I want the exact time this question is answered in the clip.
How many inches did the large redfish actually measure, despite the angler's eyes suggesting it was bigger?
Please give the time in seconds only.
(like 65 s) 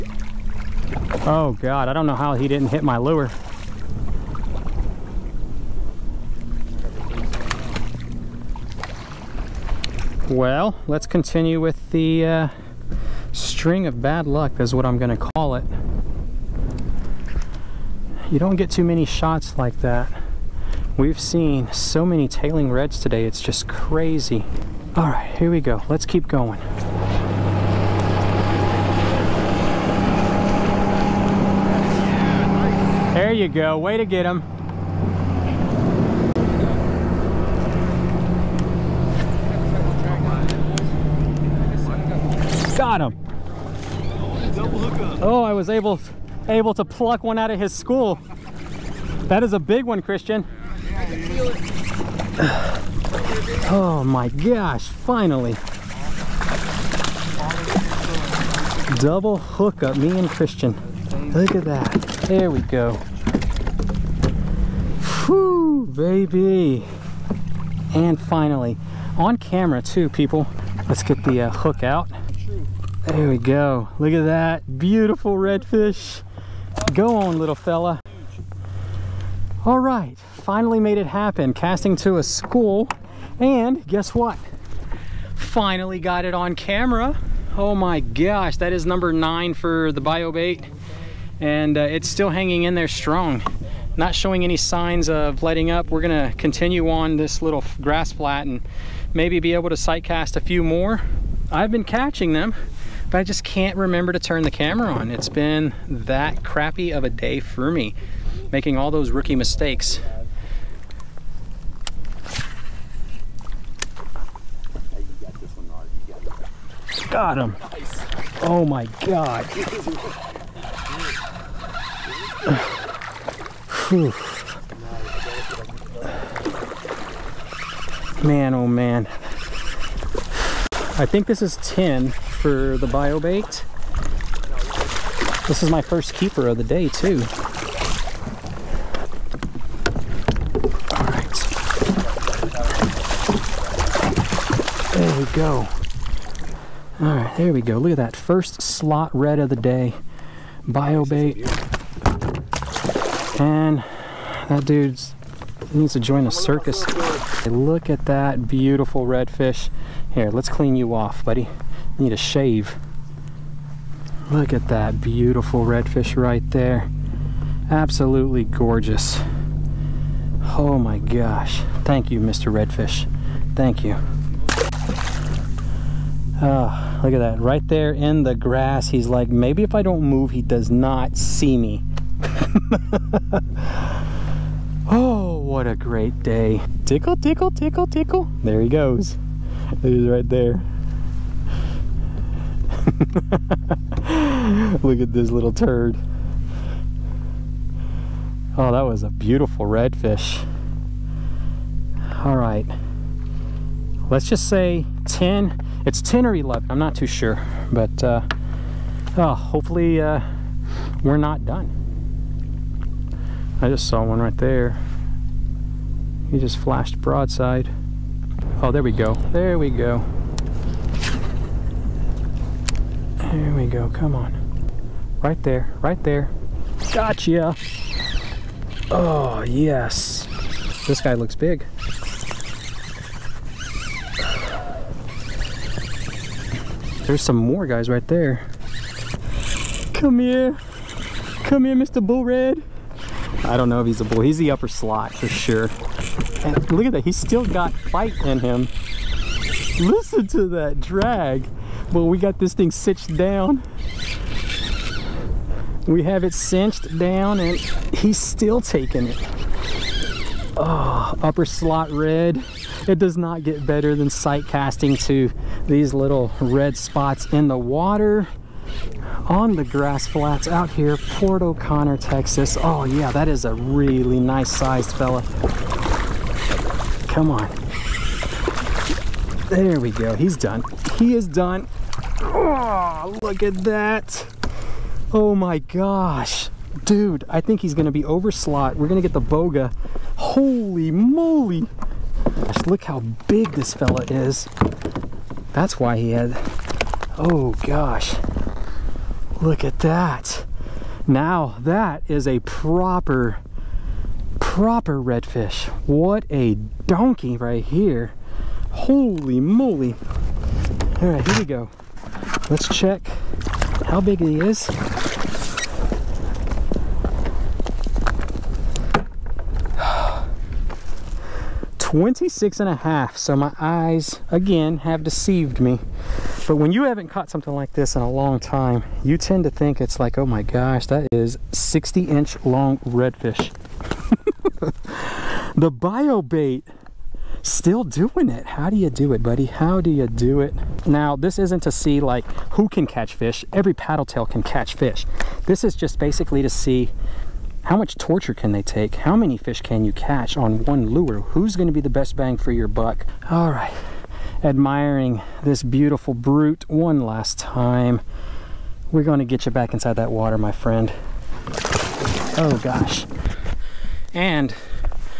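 321 s.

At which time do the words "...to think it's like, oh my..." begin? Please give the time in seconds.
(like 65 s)
329 s.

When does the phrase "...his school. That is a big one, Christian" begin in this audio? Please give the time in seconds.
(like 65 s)
47 s.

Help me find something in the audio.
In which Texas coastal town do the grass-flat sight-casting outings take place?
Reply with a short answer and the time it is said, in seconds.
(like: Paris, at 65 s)
Port O'Connor, at 270 s.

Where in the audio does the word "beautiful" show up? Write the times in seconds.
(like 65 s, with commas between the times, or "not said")
74 s, 158 s, 164 s, 199 s, 355 s.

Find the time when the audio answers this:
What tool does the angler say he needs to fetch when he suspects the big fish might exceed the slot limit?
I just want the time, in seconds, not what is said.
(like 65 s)
289 s.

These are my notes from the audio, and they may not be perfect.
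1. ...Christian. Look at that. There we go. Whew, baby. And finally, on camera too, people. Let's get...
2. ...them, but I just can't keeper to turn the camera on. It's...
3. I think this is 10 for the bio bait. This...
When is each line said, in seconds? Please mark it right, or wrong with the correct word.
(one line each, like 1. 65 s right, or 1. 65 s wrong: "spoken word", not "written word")
1. 60 s right
2. 102 s wrong: "remember", not "keeper"
3. 130 s right.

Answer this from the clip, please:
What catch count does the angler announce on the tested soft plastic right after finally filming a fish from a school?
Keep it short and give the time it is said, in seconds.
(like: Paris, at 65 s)
9, at 88 s.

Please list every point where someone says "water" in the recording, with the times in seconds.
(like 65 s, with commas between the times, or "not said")
267 s, 360 s.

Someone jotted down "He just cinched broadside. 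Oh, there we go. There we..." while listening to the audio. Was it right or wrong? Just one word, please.
wrong.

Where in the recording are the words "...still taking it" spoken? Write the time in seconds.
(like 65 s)
258 s.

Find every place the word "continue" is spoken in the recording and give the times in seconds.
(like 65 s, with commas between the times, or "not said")
11 s, 96 s.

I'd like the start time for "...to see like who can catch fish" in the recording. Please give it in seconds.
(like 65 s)
341 s.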